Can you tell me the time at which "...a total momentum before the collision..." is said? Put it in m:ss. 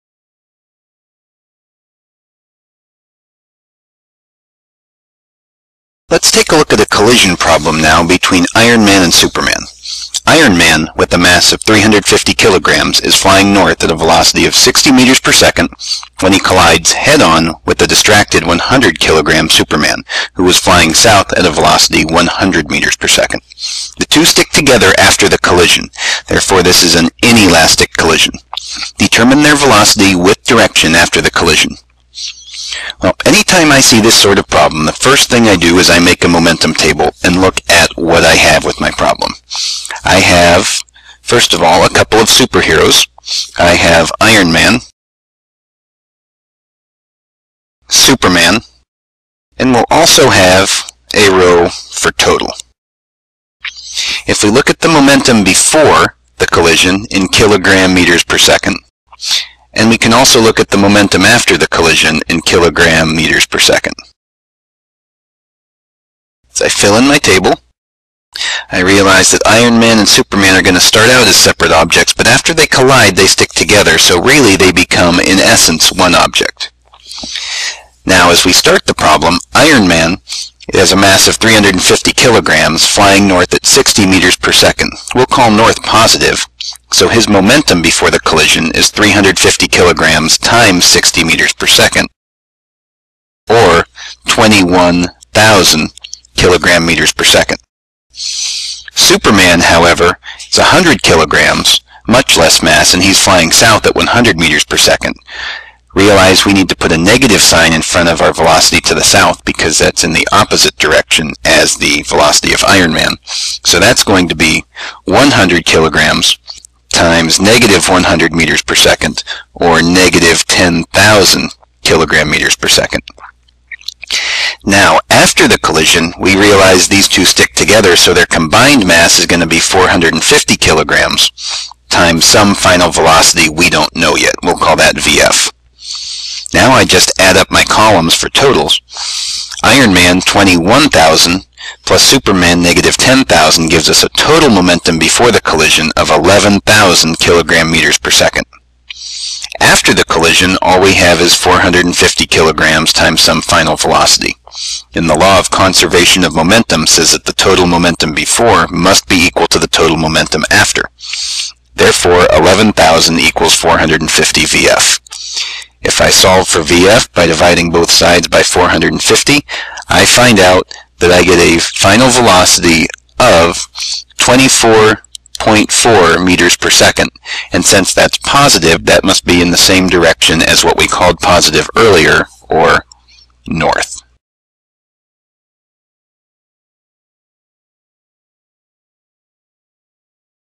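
2:24.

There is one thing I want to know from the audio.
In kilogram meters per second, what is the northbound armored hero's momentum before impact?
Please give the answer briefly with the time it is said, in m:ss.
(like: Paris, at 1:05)
21,000, at 1:34.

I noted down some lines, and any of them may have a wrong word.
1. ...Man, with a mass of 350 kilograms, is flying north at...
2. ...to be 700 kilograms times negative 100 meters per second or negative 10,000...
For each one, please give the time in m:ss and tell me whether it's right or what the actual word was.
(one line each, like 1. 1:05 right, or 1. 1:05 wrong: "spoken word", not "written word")
1. 0:10 right
2. 1:54 wrong: "100", not "700".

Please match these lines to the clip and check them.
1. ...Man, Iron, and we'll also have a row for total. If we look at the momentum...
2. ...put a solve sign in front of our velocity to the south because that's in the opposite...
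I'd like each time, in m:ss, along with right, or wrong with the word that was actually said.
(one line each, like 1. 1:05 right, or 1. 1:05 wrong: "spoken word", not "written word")
1. 0:44 wrong: "Superman", not "Iron"
2. 1:46 wrong: "negative", not "solve".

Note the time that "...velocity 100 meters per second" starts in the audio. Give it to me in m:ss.
0:21.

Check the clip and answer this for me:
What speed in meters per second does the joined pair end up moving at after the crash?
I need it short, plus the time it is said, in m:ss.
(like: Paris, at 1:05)
24.4 meters per second, at 2:54.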